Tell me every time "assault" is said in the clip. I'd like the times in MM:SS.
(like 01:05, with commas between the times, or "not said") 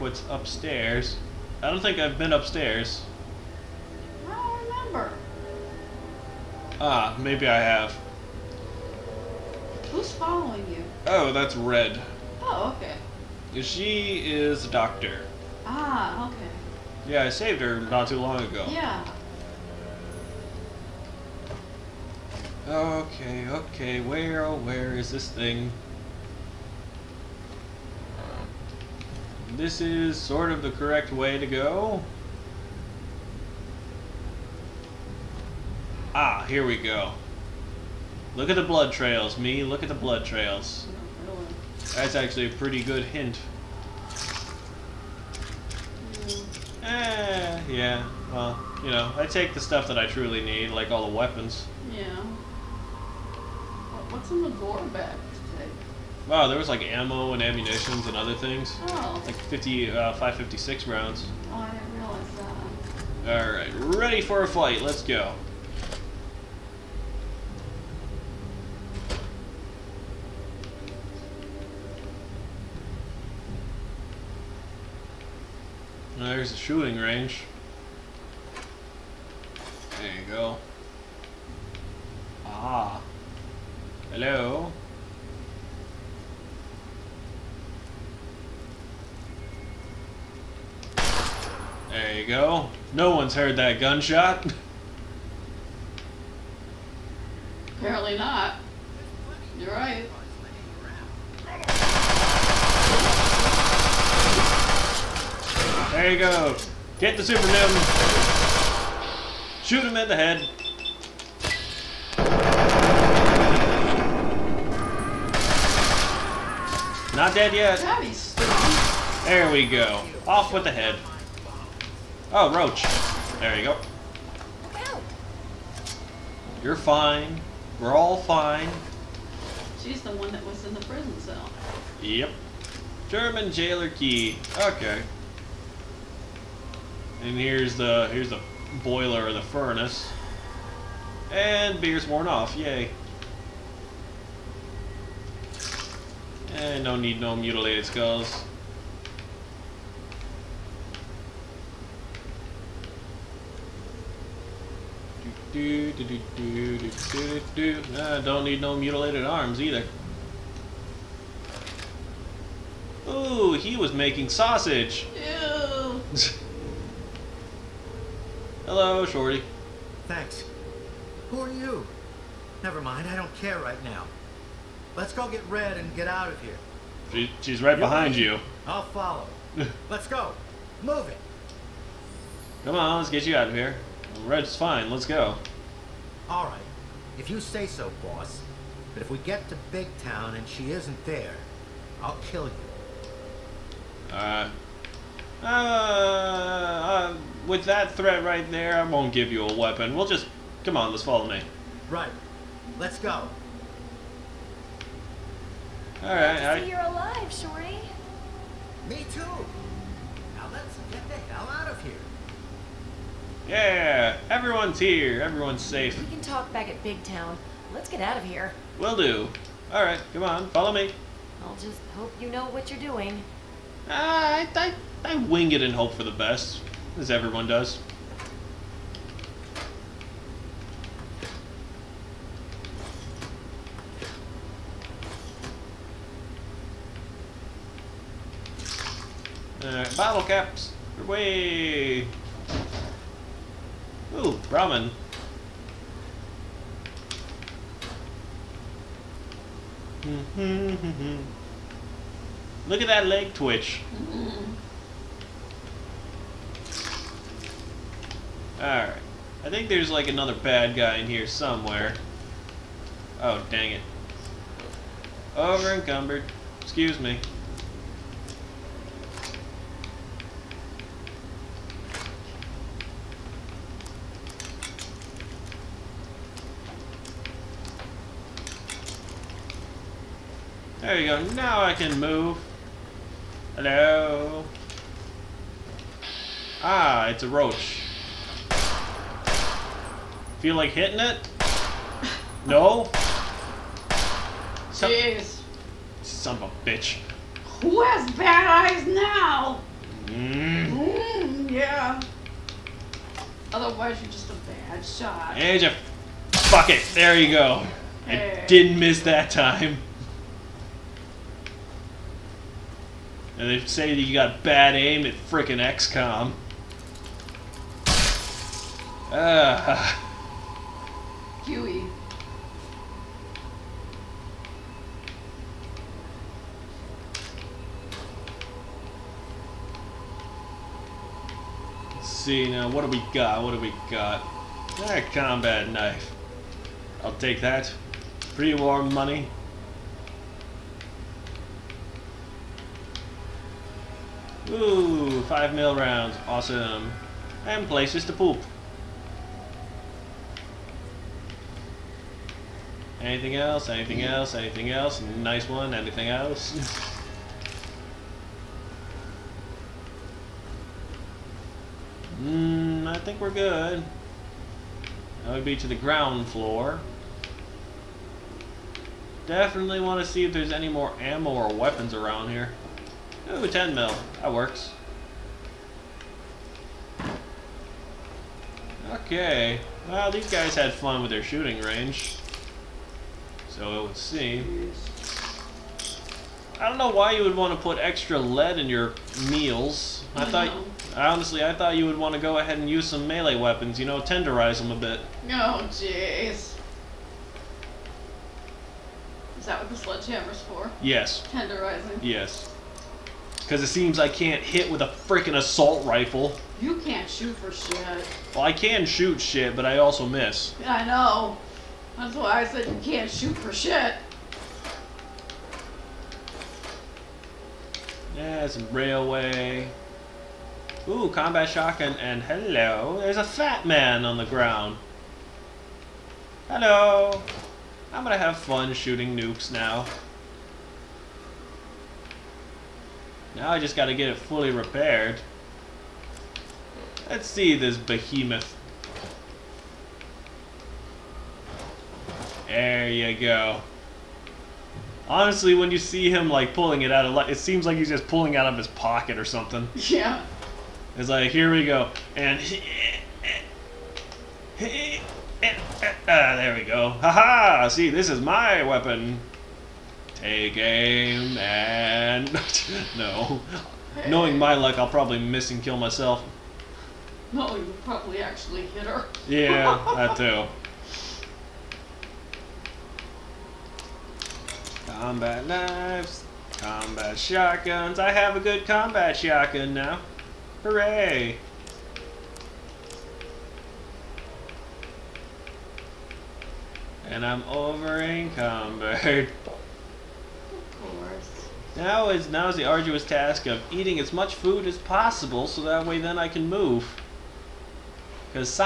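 06:45.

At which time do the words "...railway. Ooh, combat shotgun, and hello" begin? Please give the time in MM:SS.
06:58.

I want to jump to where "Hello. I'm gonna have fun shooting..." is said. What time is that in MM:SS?
07:06.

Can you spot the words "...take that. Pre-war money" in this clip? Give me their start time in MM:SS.
05:37.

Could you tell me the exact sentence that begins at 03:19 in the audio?
We'll just, come on, let's follow me.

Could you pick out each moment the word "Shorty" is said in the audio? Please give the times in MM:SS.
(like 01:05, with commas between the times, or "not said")
02:49, 03:27.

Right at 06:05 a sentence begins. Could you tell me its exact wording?
That would be to the ground floor.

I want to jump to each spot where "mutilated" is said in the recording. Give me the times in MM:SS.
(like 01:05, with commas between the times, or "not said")
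02:27, 02:38.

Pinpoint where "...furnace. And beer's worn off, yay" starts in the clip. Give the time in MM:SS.
02:19.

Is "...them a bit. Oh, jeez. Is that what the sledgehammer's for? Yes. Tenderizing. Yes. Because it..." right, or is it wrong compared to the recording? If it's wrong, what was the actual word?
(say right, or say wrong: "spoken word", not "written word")
right.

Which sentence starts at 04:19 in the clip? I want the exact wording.
I think there's like another bad guy in here somewhere.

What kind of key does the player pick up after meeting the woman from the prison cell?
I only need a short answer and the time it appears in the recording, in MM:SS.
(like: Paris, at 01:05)
German jailer key, at 02:13.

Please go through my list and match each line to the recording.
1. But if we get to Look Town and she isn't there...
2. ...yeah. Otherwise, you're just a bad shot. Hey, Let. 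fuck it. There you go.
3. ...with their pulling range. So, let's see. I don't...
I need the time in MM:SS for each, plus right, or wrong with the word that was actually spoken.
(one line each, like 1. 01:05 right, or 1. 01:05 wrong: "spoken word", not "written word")
1. 03:08 wrong: "Big", not "Look"
2. 05:01 wrong: "Jeff", not "Let"
3. 06:21 wrong: "shooting", not "pulling".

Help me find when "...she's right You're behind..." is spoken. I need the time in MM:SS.
02:57.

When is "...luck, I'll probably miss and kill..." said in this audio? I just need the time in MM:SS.
07:44.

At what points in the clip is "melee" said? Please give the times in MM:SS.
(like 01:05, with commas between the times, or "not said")
06:33.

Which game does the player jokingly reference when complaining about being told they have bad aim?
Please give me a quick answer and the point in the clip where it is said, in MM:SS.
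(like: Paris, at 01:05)
XCOM, at 05:15.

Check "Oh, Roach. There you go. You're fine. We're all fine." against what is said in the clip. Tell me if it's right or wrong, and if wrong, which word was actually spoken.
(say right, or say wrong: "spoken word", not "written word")
right.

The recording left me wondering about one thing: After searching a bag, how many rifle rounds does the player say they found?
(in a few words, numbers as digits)
50.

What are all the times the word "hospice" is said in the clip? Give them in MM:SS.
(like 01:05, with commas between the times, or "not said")
not said.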